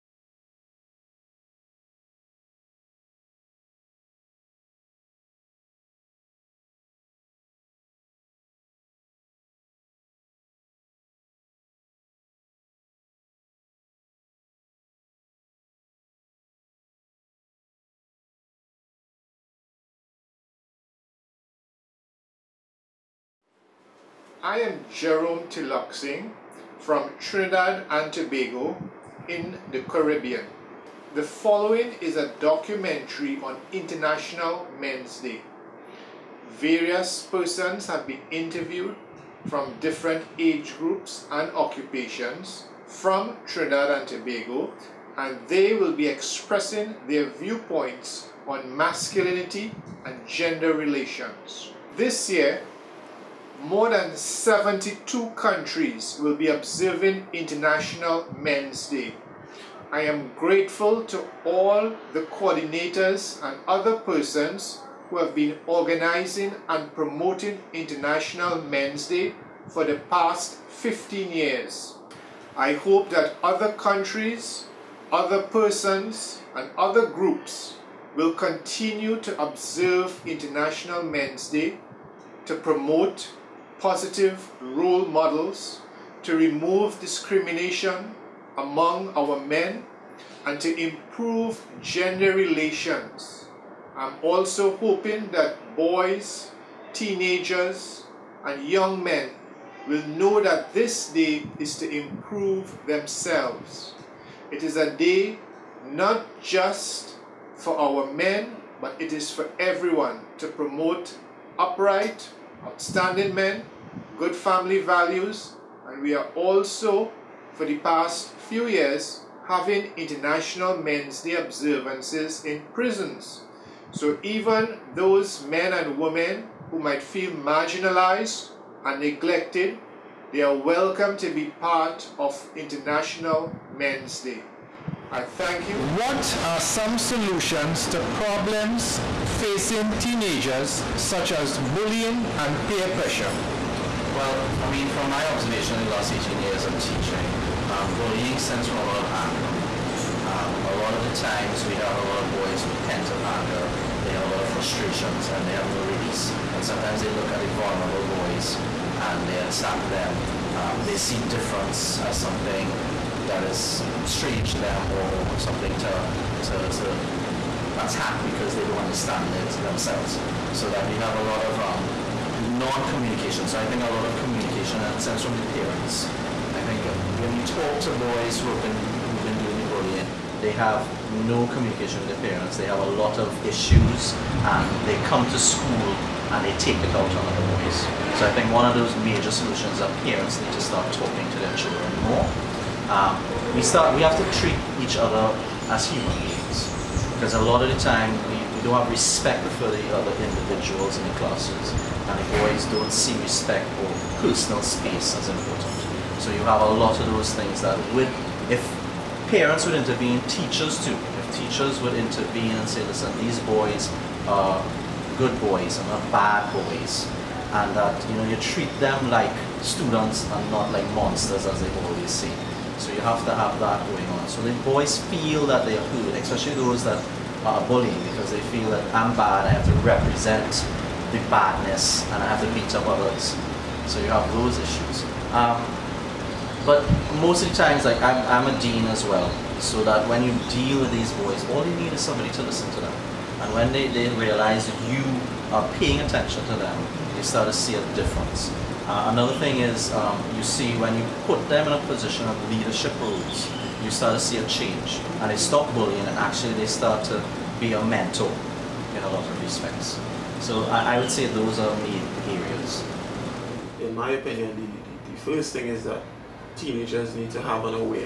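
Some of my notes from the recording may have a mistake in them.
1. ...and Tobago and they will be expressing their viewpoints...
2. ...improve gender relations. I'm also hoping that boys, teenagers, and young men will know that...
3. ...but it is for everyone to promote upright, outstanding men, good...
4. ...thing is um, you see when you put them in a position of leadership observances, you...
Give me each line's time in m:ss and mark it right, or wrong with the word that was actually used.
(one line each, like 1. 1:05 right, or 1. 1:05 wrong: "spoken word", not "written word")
1. 0:43 right
2. 1:30 right
3. 1:48 right
4. 4:09 wrong: "roles", not "observances".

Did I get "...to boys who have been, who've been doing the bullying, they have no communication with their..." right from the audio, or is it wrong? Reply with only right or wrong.
right.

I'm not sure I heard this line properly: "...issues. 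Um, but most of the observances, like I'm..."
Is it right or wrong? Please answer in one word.
wrong.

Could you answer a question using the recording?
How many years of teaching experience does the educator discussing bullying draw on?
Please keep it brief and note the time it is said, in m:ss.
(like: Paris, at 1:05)
18, at 2:26.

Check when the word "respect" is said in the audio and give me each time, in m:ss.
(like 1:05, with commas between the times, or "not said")
3:18, 3:23, 4:19.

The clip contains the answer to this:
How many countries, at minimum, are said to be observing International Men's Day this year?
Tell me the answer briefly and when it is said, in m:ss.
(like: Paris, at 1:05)
72, at 0:54.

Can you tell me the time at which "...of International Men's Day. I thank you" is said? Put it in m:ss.
2:12.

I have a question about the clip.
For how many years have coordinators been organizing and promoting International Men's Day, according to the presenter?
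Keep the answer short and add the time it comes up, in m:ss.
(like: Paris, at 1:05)
15, at 1:10.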